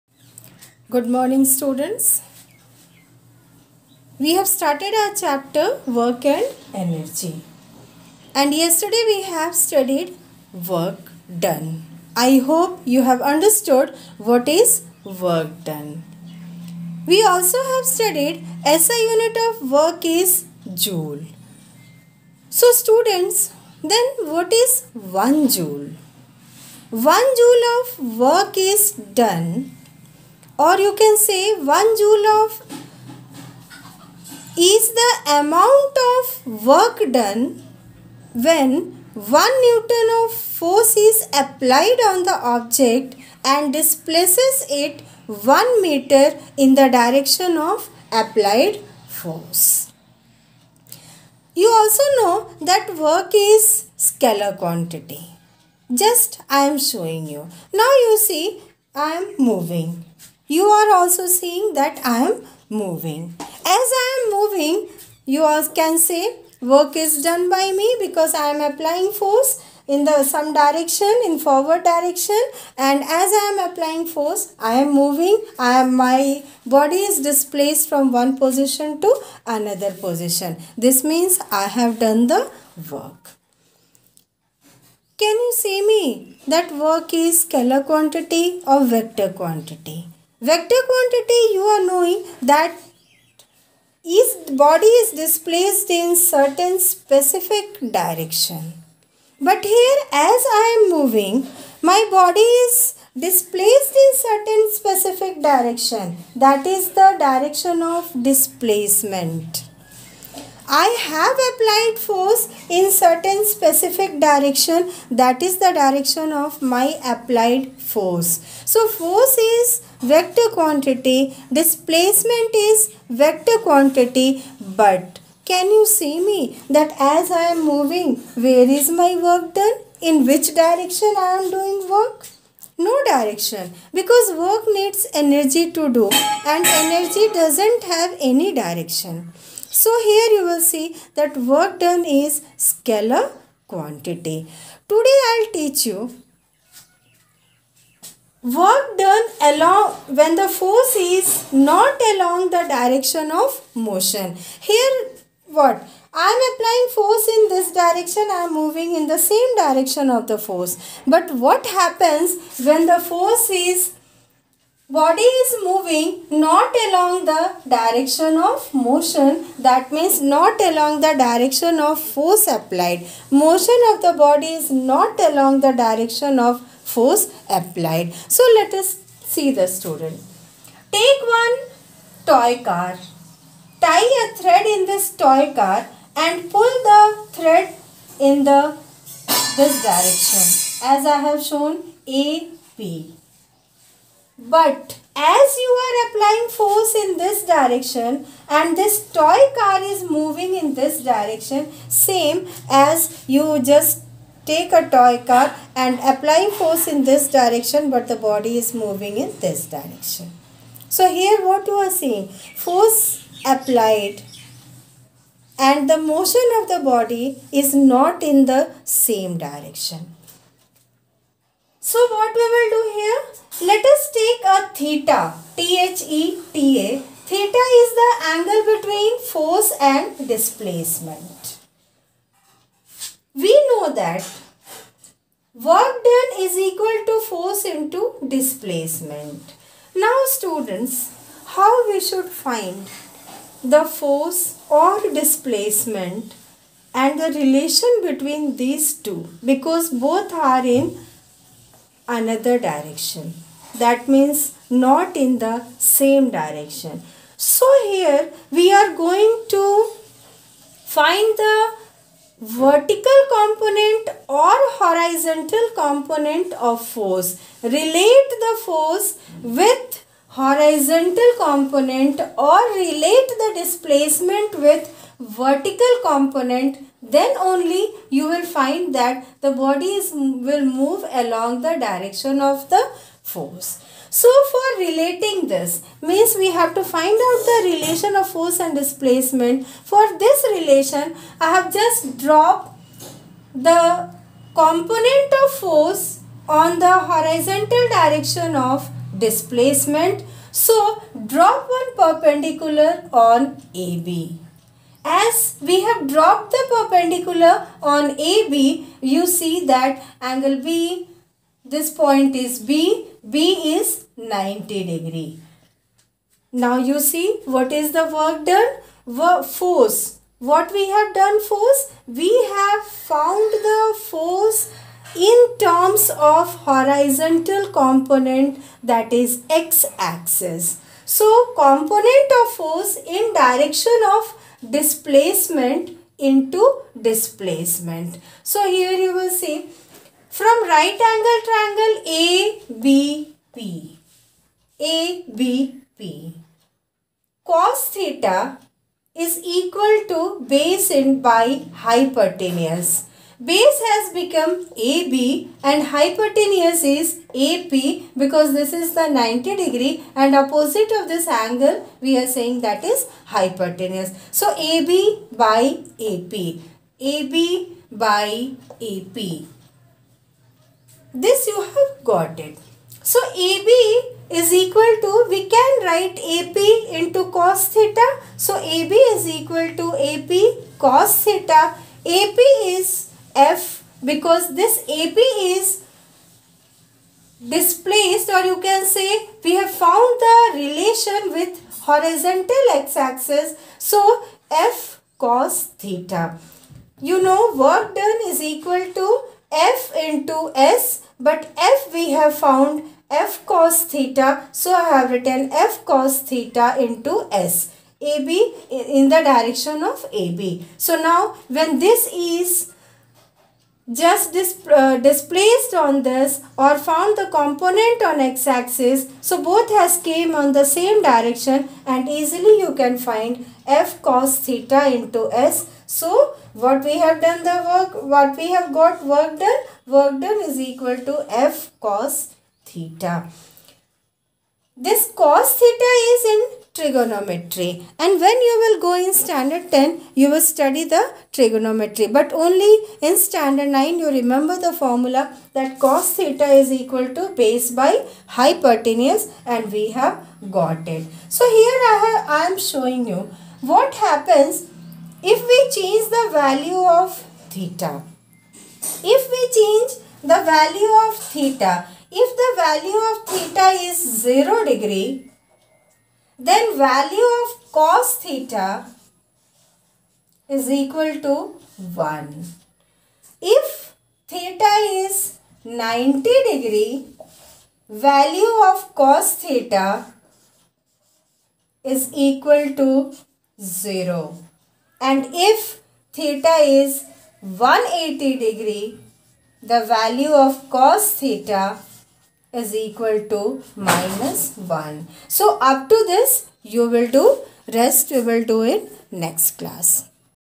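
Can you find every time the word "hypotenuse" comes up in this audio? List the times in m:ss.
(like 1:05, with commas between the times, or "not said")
5:51, 5:55, 6:03, 7:28.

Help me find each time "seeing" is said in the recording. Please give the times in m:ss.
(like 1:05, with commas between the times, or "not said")
1:01, 3:31.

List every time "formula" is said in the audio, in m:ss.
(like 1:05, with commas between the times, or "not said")
7:24.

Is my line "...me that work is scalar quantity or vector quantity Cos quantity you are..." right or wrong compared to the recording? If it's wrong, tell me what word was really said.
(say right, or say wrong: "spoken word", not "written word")
wrong: "Vector", not "Cos".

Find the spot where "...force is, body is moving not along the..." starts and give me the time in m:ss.
2:42.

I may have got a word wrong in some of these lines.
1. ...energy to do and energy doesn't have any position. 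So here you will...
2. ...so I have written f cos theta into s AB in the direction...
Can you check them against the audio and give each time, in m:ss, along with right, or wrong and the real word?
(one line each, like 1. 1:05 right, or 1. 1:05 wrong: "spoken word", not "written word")
1. 2:15 wrong: "direction", not "position"
2. 6:44 right.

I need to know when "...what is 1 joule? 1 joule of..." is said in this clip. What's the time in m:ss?
0:24.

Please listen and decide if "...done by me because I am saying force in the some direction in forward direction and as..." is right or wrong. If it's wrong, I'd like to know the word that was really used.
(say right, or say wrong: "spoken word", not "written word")
wrong: "applying", not "saying".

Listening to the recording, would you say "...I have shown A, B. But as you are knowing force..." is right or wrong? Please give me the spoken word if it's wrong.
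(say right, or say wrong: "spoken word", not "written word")
wrong: "applying", not "knowing".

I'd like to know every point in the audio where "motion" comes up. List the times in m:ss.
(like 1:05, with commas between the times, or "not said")
2:33, 2:48, 2:53, 3:35.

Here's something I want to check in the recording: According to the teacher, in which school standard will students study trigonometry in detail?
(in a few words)
Standard 10.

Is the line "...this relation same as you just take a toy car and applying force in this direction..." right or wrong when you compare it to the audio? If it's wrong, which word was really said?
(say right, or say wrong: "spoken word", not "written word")
wrong: "direction", not "relation".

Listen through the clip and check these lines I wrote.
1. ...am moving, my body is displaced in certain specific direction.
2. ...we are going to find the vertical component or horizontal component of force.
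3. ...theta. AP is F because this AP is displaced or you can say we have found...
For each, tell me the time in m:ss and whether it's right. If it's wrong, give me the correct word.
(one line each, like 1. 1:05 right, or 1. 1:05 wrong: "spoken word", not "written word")
1. 1:40 right
2. 4:18 right
3. 6:21 right.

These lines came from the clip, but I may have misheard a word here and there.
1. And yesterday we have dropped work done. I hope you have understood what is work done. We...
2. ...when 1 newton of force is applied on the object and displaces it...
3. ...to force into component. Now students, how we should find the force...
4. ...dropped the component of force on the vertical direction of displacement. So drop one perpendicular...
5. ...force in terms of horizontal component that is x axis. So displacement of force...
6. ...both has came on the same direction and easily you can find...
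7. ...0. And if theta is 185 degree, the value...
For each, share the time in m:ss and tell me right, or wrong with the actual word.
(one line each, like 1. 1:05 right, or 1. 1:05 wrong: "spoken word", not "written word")
1. 0:08 wrong: "studied", not "dropped"
2. 0:38 right
3. 3:57 wrong: "displacement", not "component"
4. 4:52 wrong: "horizontal", not "vertical"
5. 5:24 wrong: "component", not "displacement"
6. 6:59 right
7. 8:03 wrong: "180", not "185".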